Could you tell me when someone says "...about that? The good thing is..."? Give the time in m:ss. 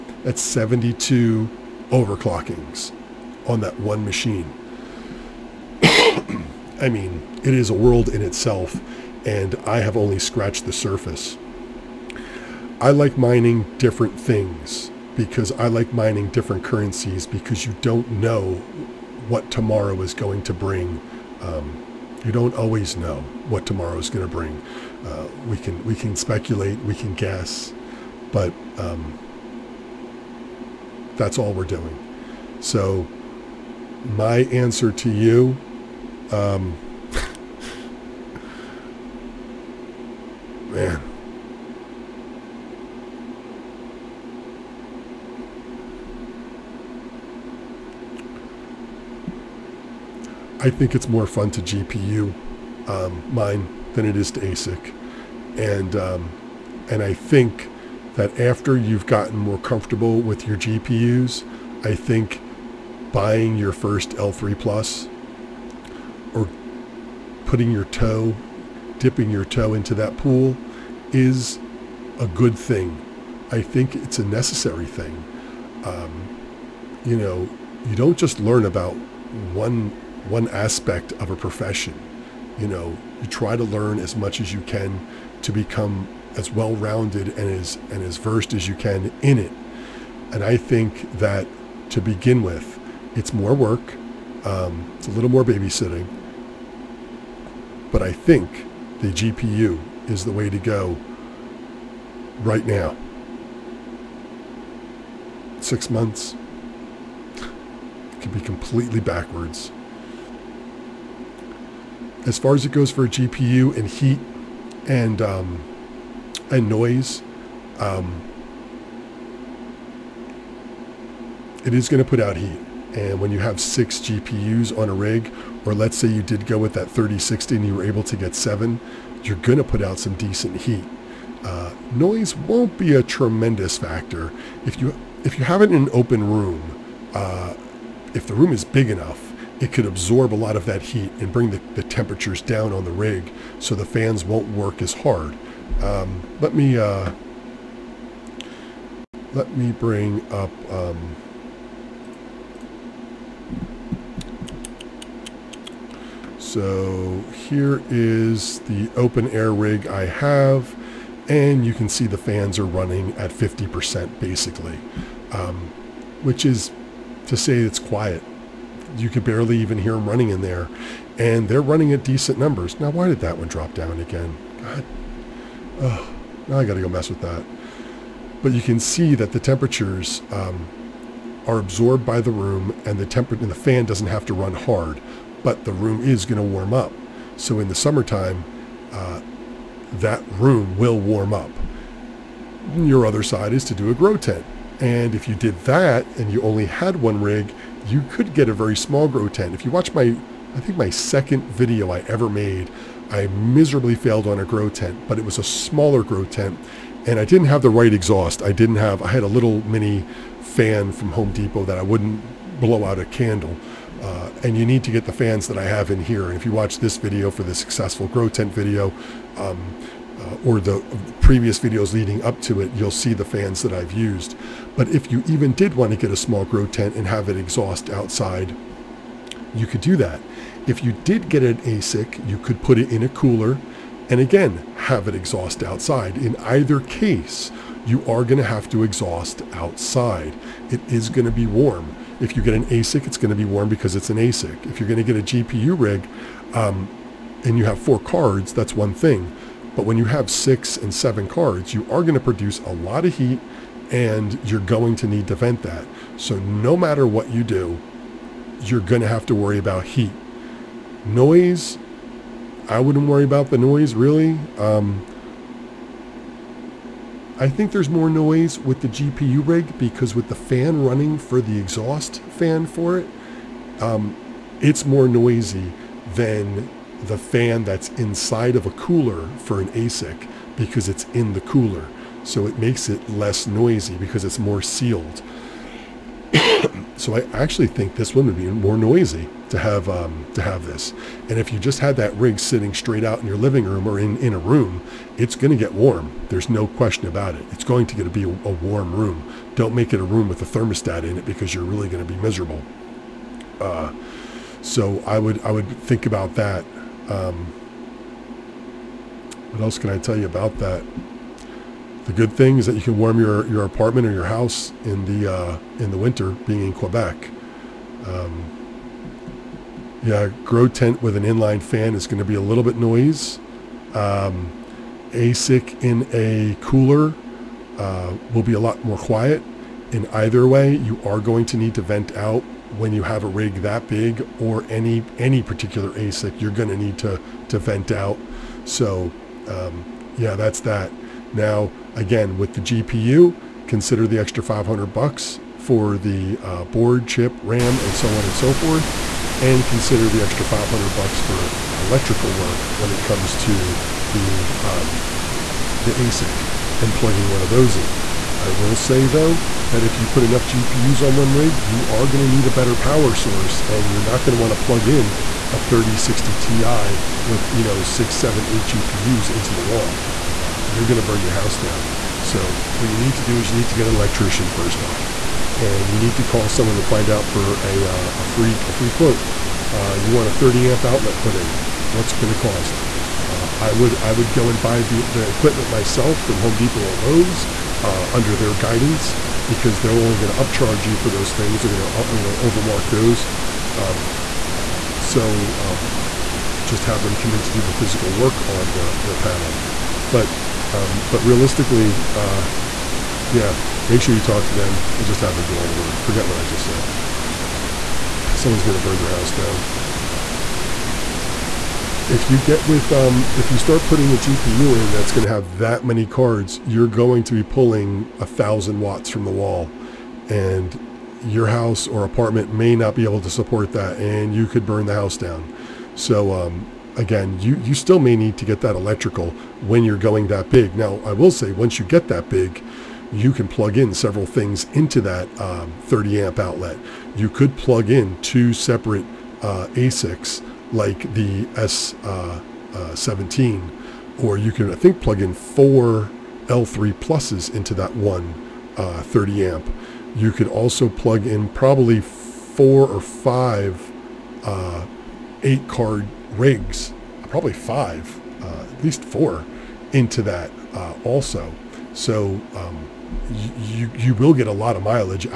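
5:10.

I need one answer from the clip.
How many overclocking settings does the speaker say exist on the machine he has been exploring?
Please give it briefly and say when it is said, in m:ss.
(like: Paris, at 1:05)
72, at 0:00.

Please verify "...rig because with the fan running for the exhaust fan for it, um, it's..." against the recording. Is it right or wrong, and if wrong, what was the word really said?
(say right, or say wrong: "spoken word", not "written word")
right.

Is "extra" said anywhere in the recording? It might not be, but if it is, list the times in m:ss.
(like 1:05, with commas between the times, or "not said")
5:44, 5:50.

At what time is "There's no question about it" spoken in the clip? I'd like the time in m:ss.
4:56.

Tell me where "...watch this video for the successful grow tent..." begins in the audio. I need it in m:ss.
3:36.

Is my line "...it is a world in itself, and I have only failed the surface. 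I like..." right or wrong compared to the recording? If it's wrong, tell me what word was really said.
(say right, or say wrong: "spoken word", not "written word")
wrong: "scratched", not "failed".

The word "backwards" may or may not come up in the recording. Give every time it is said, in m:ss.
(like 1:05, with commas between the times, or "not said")
1:48.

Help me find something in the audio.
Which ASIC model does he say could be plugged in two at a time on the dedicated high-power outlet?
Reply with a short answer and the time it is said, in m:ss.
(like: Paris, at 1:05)
S17, at 7:21.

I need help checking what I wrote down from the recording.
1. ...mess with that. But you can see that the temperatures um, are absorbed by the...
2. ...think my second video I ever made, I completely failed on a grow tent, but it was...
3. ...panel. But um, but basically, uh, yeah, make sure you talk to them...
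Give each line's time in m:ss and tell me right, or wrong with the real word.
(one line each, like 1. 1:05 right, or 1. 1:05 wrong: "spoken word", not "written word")
1. 2:56 right
2. 3:20 wrong: "miserably", not "completely"
3. 6:39 wrong: "realistically", not "basically".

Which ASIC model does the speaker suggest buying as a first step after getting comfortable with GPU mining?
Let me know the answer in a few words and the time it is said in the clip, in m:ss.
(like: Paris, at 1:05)
L3 Plus, at 1:04.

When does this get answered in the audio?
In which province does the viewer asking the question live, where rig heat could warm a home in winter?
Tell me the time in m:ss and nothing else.
5:16.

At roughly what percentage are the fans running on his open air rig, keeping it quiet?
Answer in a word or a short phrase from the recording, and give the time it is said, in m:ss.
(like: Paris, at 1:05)
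50%, at 2:43.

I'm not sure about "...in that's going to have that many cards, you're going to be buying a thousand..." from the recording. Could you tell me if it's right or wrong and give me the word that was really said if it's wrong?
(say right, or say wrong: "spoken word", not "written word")
wrong: "pulling", not "buying".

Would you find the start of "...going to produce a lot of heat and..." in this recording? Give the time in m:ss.
4:12.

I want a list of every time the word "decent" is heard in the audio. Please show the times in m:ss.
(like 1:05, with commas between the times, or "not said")
2:10, 2:52.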